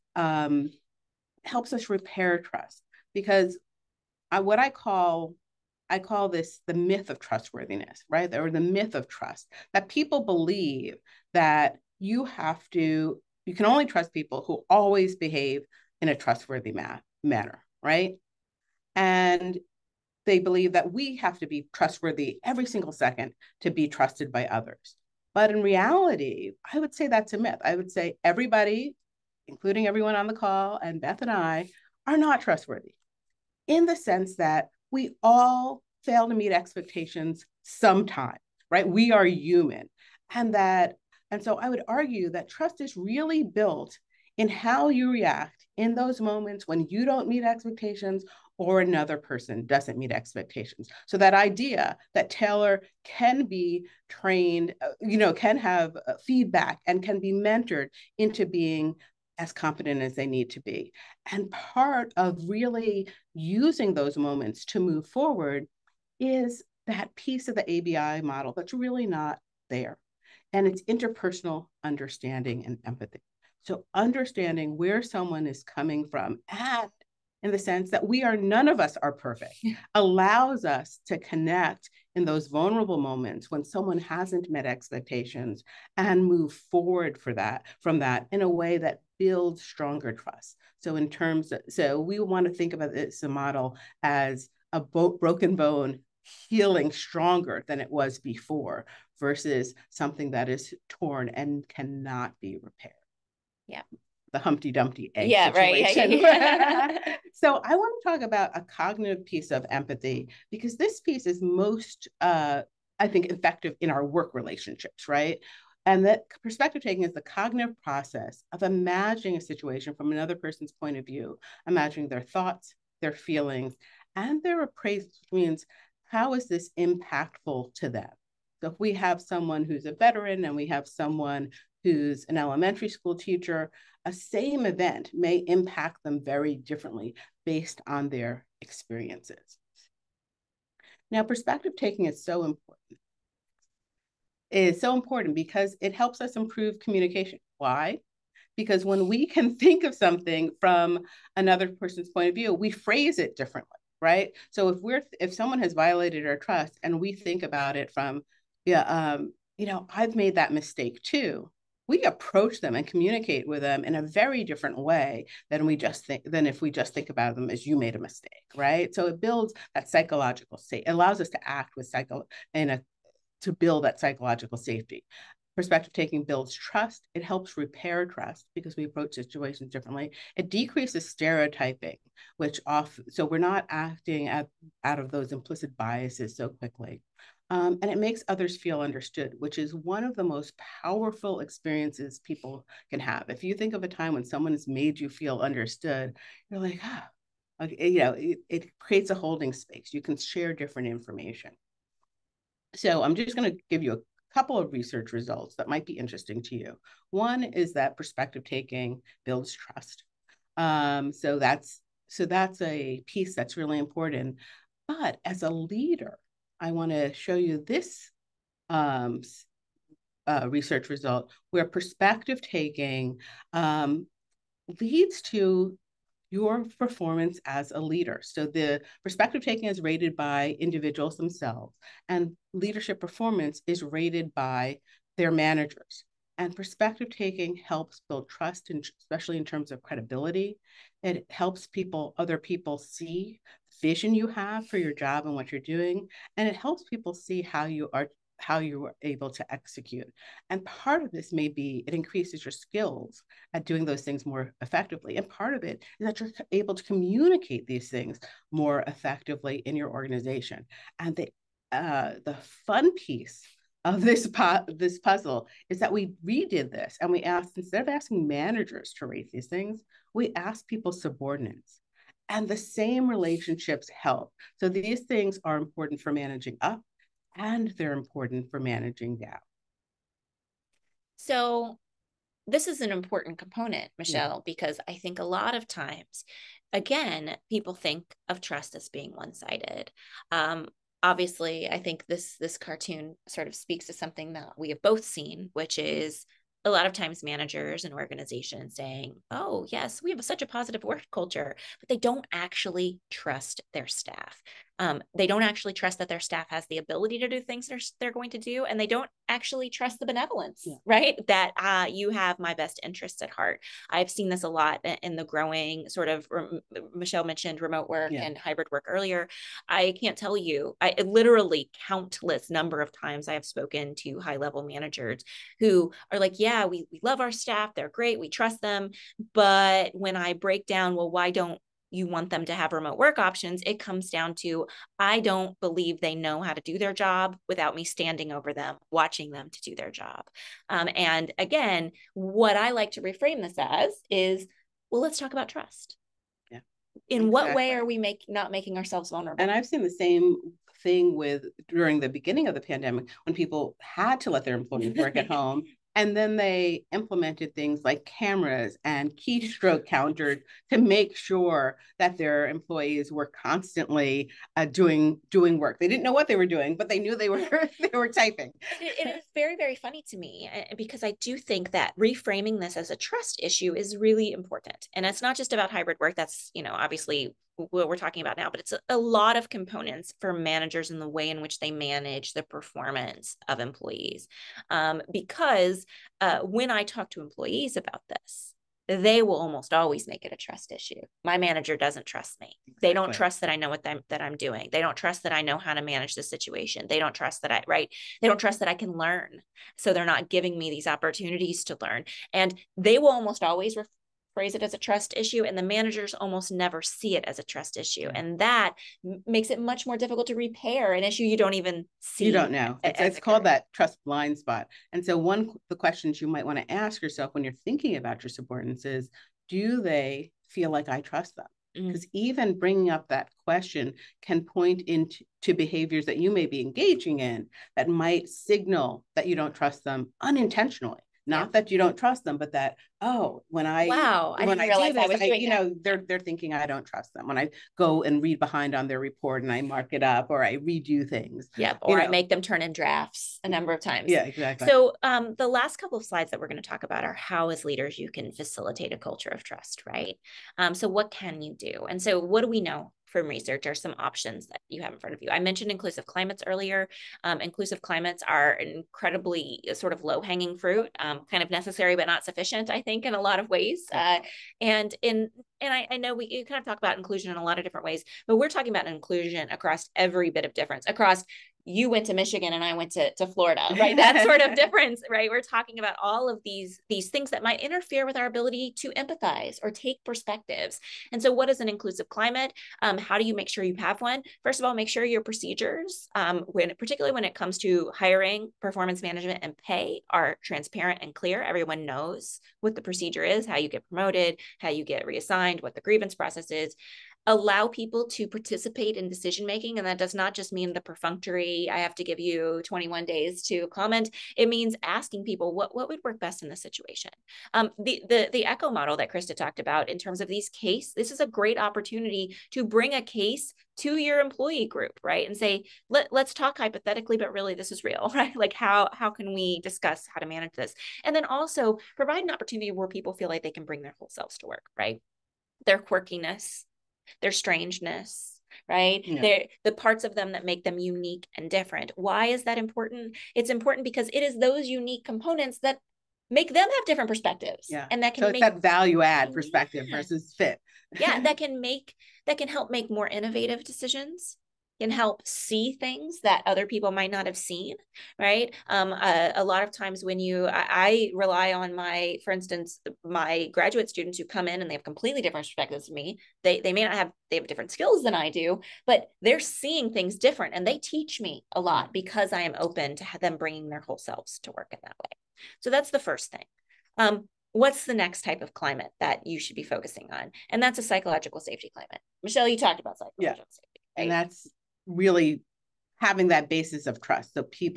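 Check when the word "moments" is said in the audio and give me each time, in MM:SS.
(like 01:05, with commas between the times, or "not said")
00:46, 01:04, 01:22.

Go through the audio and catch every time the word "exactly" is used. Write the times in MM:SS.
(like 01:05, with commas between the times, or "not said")
05:47, 06:32, 07:24.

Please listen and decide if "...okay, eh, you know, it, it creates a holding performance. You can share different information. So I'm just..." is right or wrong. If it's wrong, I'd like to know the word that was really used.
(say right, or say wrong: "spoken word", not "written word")
wrong: "space", not "performance".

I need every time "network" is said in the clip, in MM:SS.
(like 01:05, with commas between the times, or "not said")
not said.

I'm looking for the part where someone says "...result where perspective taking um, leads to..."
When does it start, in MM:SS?
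03:40.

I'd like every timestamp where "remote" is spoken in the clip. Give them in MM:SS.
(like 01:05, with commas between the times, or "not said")
05:17, 05:32.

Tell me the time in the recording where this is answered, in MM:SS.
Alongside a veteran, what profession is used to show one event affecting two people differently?
02:12.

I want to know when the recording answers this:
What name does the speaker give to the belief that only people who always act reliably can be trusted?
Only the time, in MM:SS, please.
00:06.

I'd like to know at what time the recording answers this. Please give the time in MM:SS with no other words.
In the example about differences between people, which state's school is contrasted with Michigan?
07:53.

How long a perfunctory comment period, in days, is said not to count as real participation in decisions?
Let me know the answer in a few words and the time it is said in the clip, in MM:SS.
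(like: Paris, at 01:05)
21, at 08:22.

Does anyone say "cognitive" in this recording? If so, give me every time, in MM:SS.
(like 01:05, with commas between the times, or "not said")
01:48, 01:57.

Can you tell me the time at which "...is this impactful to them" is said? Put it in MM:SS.
02:06.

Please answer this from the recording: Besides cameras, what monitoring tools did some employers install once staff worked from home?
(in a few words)
keystroke counters.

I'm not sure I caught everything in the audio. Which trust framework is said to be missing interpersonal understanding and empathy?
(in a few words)
ABI model.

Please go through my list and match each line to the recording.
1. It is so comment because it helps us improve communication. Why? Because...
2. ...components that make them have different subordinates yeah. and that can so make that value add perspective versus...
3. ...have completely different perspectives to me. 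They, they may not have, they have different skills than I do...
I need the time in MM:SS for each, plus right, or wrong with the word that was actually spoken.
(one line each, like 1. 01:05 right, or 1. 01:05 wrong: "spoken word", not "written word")
1. 02:24 wrong: "important", not "comment"
2. 08:55 wrong: "perspectives", not "subordinates"
3. 09:14 right.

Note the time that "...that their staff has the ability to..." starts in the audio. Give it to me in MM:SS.
05:05.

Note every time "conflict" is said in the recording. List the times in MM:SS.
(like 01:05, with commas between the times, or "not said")
not said.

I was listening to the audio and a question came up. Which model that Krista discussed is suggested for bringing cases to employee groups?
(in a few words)
echo model.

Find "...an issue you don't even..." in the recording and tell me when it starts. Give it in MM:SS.
06:50.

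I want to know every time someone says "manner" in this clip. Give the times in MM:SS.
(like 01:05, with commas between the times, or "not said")
00:17.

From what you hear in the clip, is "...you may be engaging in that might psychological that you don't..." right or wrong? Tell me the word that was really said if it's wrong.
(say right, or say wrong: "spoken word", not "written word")
wrong: "signal", not "psychological".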